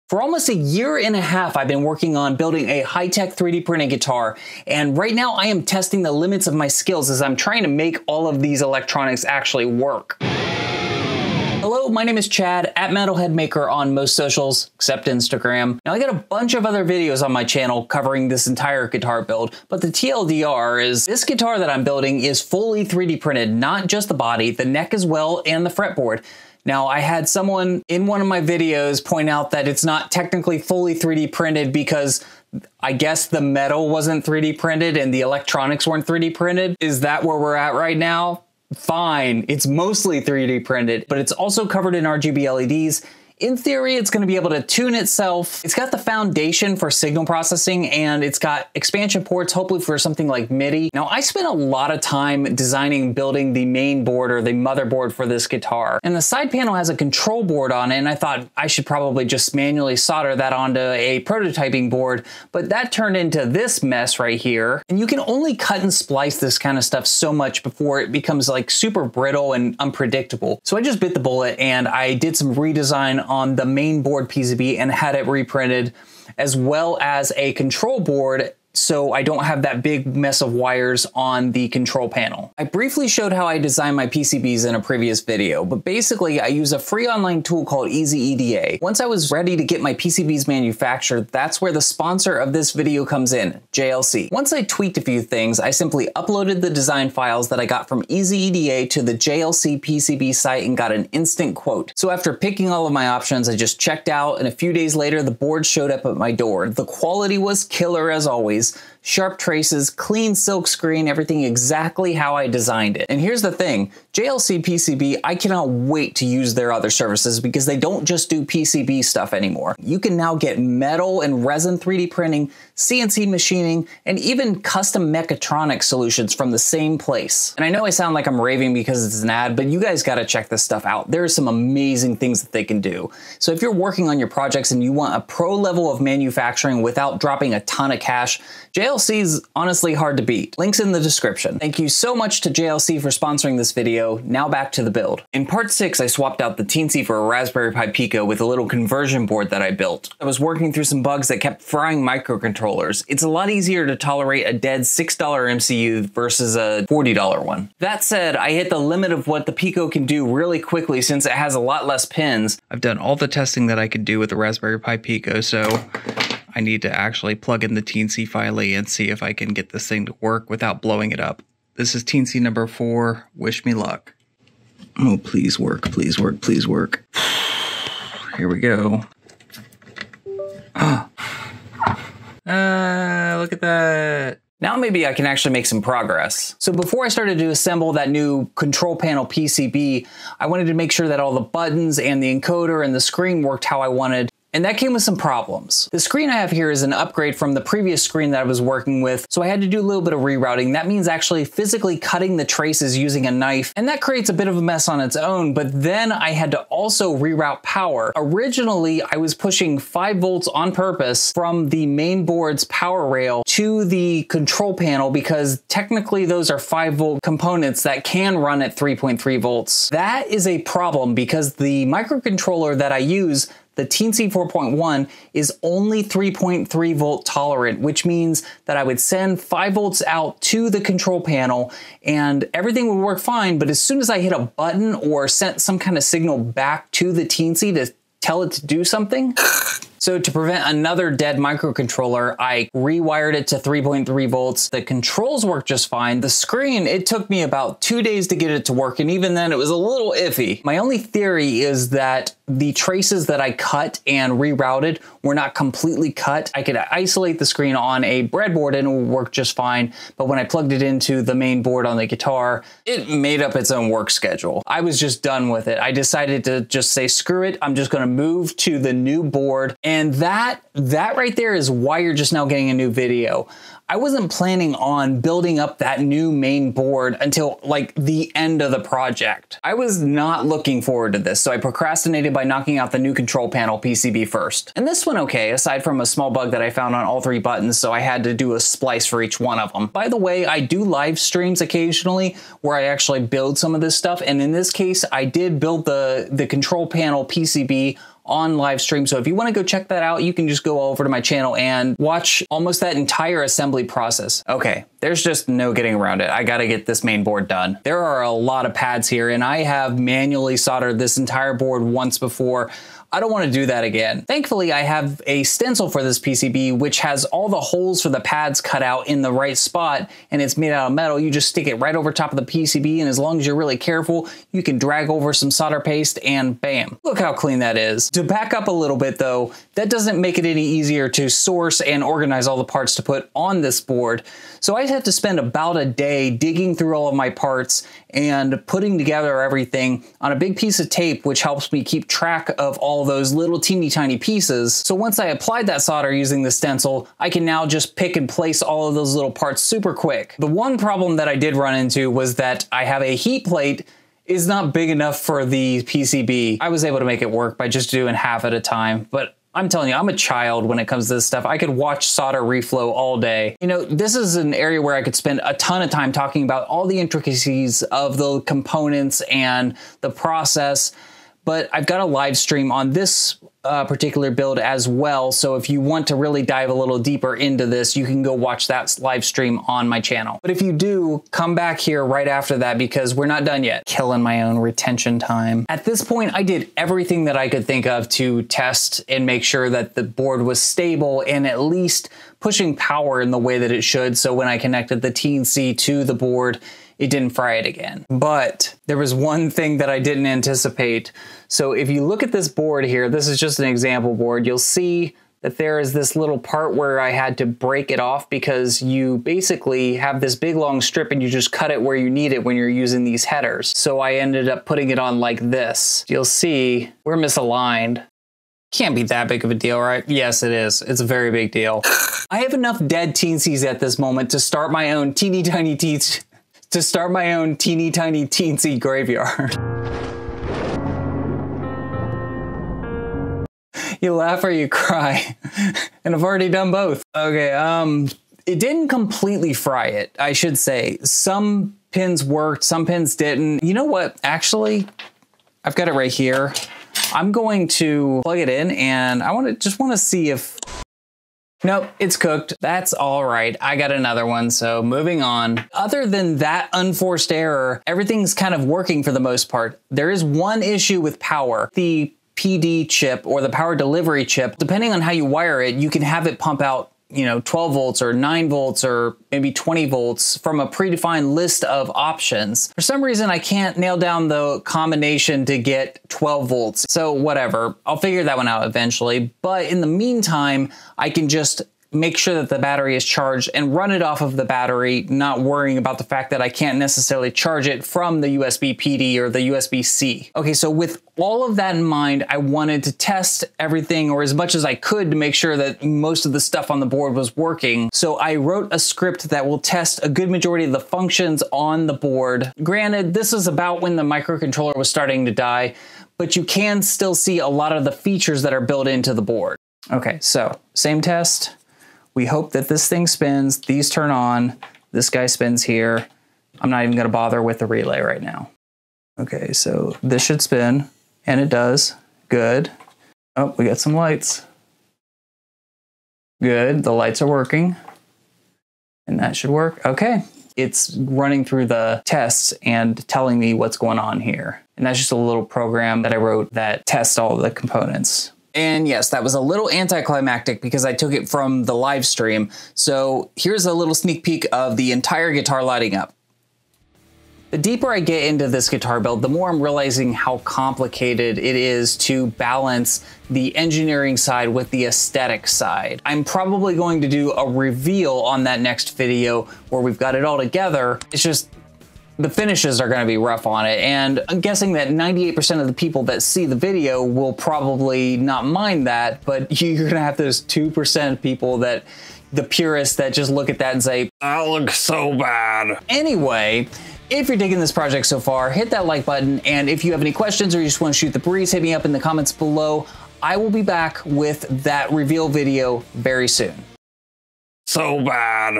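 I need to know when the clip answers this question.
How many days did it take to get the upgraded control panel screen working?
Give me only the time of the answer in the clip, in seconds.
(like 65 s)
247 s.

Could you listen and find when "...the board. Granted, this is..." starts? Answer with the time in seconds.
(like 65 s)
501 s.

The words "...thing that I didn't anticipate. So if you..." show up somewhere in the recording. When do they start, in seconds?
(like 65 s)
399 s.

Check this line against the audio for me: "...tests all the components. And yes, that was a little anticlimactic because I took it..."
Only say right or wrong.
right.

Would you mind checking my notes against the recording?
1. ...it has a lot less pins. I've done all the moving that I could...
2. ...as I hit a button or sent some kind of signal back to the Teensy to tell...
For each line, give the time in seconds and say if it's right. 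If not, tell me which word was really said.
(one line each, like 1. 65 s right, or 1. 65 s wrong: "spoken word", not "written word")
1. 161 s wrong: "testing", not "moving"
2. 233 s right.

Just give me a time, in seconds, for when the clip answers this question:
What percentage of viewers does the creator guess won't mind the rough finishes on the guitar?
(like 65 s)
564 s.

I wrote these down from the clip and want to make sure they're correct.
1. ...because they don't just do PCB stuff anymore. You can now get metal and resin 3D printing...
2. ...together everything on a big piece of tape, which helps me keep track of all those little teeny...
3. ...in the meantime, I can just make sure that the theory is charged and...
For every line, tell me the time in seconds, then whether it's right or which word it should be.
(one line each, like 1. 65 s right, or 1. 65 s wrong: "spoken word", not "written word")
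1. 117 s right
2. 338 s right
3. 479 s wrong: "battery", not "theory".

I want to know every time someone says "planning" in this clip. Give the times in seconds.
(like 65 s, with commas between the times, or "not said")
274 s.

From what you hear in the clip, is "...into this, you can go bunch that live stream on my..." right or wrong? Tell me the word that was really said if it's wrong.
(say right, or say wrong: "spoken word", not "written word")
wrong: "watch", not "bunch".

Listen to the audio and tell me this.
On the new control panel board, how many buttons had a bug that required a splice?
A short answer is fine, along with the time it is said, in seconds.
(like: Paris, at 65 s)
3, at 287 s.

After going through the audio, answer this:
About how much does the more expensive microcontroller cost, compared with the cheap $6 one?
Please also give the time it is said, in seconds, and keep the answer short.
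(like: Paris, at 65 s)
$40, at 156 s.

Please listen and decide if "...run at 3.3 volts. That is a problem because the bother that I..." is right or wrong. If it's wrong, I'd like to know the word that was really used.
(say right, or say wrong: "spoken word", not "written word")
wrong: "microcontroller", not "bother".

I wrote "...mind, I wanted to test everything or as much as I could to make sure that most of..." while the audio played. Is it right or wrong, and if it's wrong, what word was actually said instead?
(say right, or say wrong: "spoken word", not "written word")
right.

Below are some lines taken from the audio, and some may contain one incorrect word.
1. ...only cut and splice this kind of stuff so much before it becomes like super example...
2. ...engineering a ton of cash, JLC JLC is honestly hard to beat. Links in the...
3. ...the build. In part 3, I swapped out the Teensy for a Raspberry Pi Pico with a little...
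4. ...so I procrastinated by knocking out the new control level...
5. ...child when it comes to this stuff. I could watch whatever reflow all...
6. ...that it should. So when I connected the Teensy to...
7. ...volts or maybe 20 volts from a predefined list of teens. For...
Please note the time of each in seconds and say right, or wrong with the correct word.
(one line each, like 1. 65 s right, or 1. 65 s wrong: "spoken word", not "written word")
1. 65 s wrong: "brittle", not "example"
2. 137 s wrong: "dropping", not "engineering"
3. 144 s wrong: "6", not "3"
4. 281 s wrong: "panel", not "level"
5. 360 s wrong: "solder", not "whatever"
6. 393 s right
7. 468 s wrong: "options", not "teens".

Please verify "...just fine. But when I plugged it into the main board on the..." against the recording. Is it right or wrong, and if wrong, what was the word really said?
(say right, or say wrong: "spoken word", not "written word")
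right.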